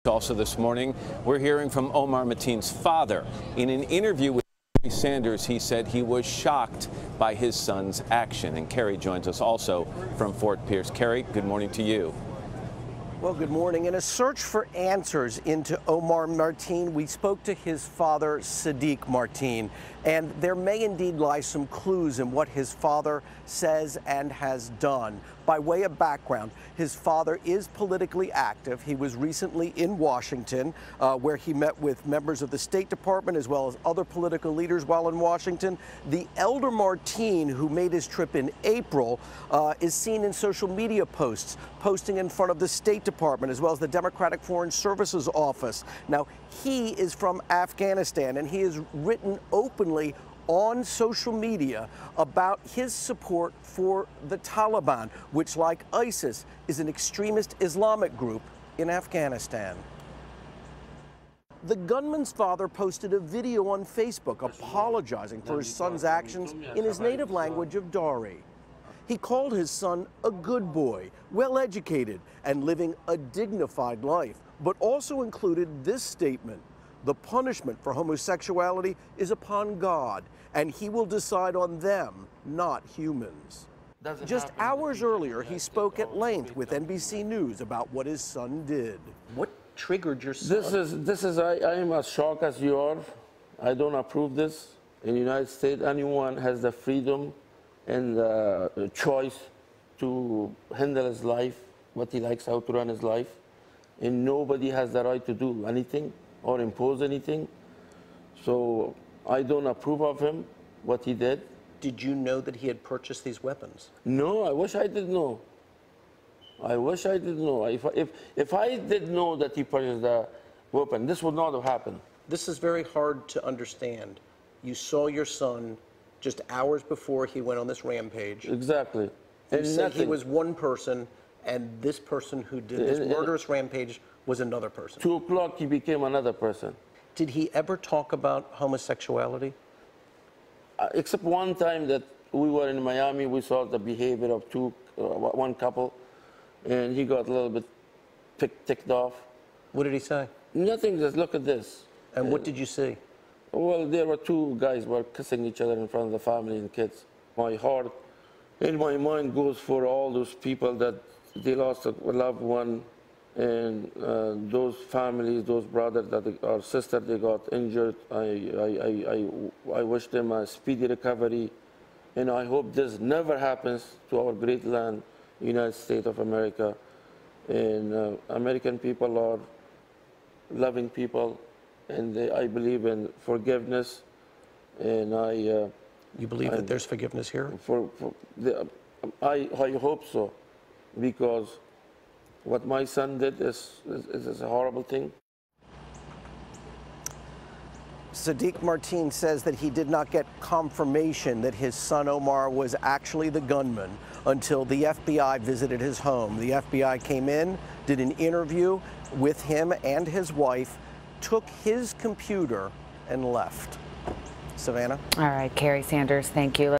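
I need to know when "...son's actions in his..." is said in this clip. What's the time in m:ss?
1:05.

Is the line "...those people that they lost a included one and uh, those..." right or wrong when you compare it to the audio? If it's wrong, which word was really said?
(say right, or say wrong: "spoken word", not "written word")
wrong: "loved", not "included".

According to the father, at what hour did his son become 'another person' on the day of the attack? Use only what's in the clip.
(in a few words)
2 o'clock.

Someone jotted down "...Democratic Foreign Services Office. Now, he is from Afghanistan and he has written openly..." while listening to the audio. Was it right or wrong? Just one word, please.
right.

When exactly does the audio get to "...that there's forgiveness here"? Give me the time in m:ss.
3:06.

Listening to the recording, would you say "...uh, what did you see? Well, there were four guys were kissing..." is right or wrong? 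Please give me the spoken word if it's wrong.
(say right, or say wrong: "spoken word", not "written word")
wrong: "two", not "four".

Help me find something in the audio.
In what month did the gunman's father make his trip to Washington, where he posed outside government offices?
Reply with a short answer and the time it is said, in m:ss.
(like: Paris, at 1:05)
April, at 0:38.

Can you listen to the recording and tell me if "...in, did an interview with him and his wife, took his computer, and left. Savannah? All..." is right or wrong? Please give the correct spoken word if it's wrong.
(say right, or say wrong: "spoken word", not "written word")
right.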